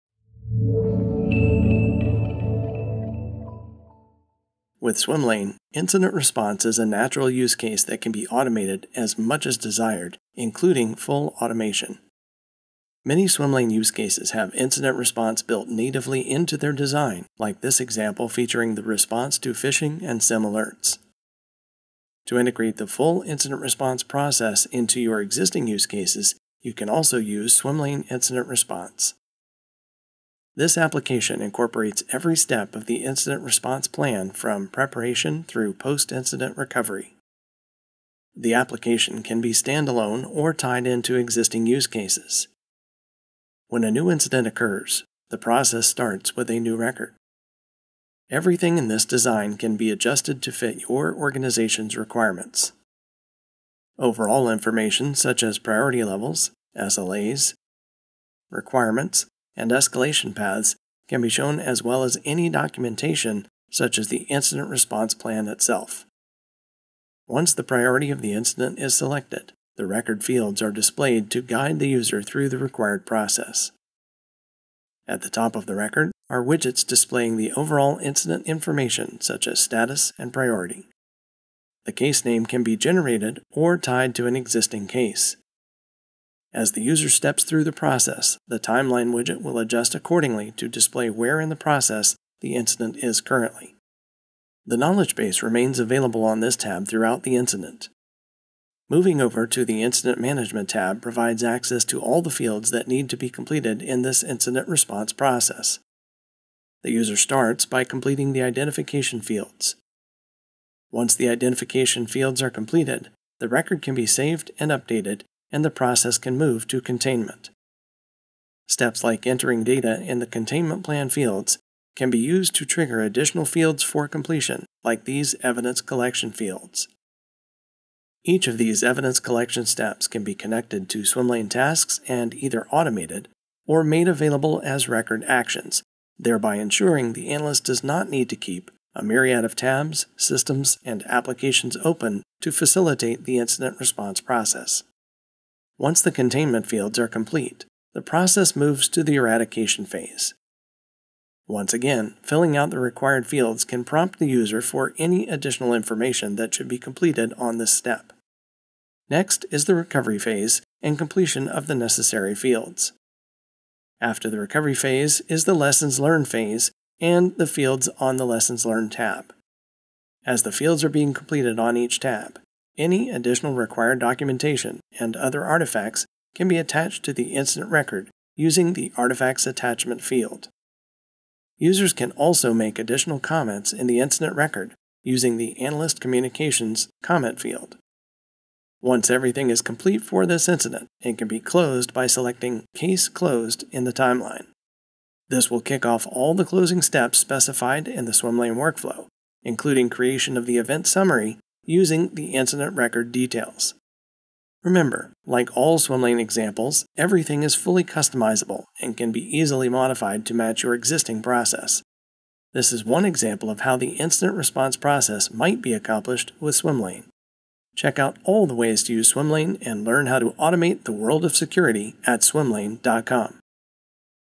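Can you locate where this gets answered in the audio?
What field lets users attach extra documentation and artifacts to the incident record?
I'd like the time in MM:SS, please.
02:58.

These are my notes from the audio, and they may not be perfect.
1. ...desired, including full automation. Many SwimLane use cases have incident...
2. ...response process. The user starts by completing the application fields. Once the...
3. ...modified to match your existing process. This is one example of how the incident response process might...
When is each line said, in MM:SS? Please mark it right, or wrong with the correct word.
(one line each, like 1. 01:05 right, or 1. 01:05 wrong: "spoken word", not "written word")
1. 00:09 right
2. 01:44 wrong: "identification", not "application"
3. 03:29 right.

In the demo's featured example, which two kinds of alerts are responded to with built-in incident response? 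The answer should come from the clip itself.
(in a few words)
phishing and SIEM.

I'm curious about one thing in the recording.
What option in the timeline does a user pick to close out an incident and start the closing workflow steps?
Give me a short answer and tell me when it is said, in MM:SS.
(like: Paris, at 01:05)
Case Closed, at 03:12.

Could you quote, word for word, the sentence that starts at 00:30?
This application incorporates every step of the incident response plan from preparation through post incident recovery.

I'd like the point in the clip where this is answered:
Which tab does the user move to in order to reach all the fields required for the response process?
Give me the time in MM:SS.
01:39.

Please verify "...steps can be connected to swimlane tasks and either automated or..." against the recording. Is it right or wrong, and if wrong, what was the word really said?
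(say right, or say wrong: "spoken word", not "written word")
right.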